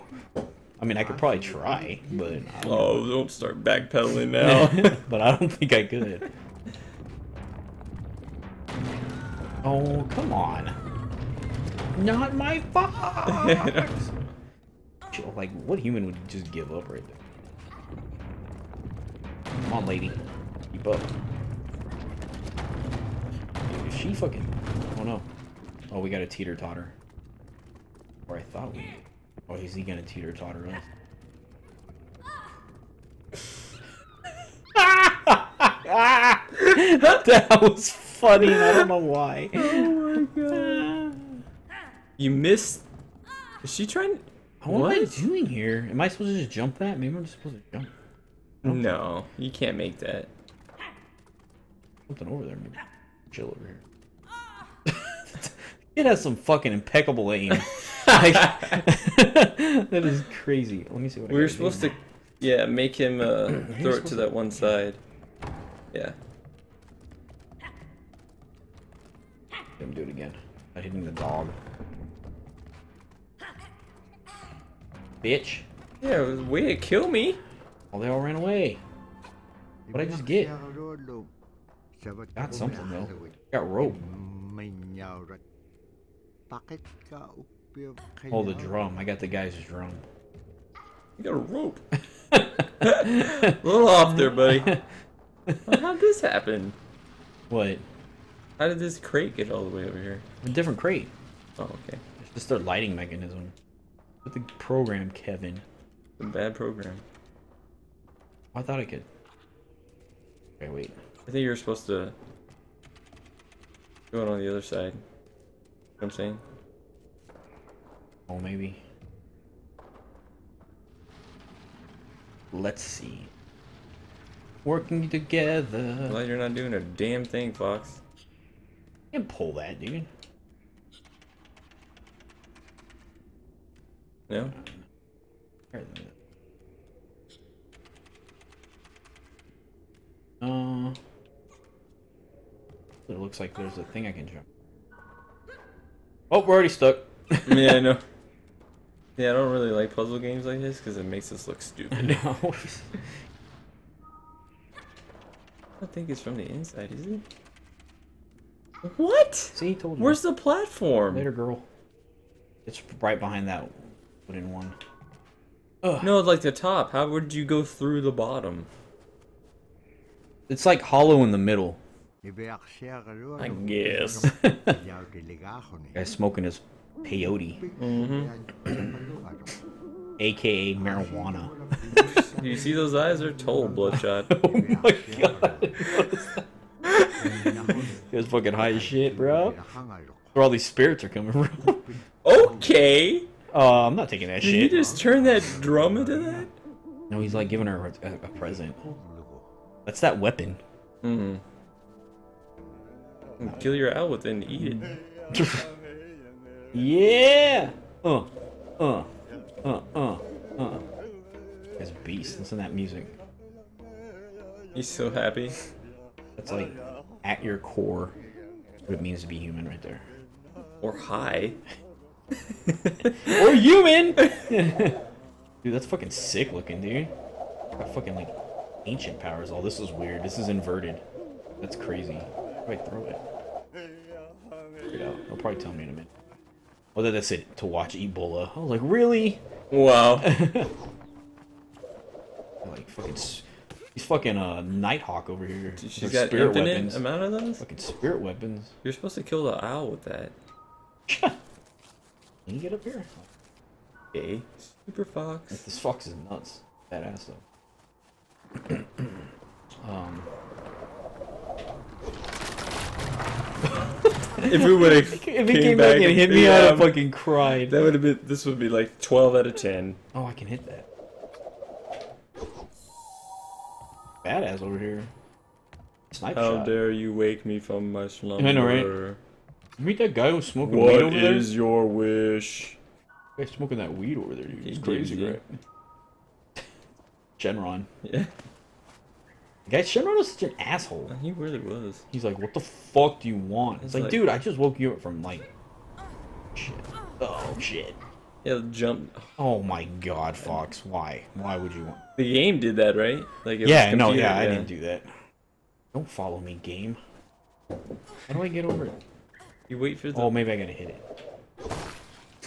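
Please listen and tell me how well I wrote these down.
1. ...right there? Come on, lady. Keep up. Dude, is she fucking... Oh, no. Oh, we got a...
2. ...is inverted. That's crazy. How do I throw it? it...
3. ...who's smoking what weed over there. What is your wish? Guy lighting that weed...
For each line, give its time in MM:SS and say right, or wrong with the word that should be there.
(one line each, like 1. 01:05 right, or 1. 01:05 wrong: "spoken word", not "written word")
1. 00:16 right
2. 03:50 right
3. 04:40 wrong: "smoking", not "lighting".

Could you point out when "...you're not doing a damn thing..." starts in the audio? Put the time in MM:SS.
02:06.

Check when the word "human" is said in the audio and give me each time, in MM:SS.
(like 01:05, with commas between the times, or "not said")
00:15, 03:39, 03:43.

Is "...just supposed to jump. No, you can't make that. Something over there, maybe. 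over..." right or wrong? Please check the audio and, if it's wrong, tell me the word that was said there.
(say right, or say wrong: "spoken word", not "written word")
right.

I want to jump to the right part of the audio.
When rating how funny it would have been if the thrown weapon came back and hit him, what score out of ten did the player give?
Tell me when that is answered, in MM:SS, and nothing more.
04:28.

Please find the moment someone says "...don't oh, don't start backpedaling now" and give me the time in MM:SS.
00:02.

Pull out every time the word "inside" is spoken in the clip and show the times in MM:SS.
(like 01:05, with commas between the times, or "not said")
02:36.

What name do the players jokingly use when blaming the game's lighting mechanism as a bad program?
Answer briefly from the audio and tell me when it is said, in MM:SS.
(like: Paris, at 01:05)
Kevin, at 01:45.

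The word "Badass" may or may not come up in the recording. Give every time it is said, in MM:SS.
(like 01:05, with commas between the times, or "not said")
04:16, 04:34.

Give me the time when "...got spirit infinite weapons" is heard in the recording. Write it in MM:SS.
04:06.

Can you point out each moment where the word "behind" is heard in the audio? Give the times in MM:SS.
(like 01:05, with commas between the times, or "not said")
02:43.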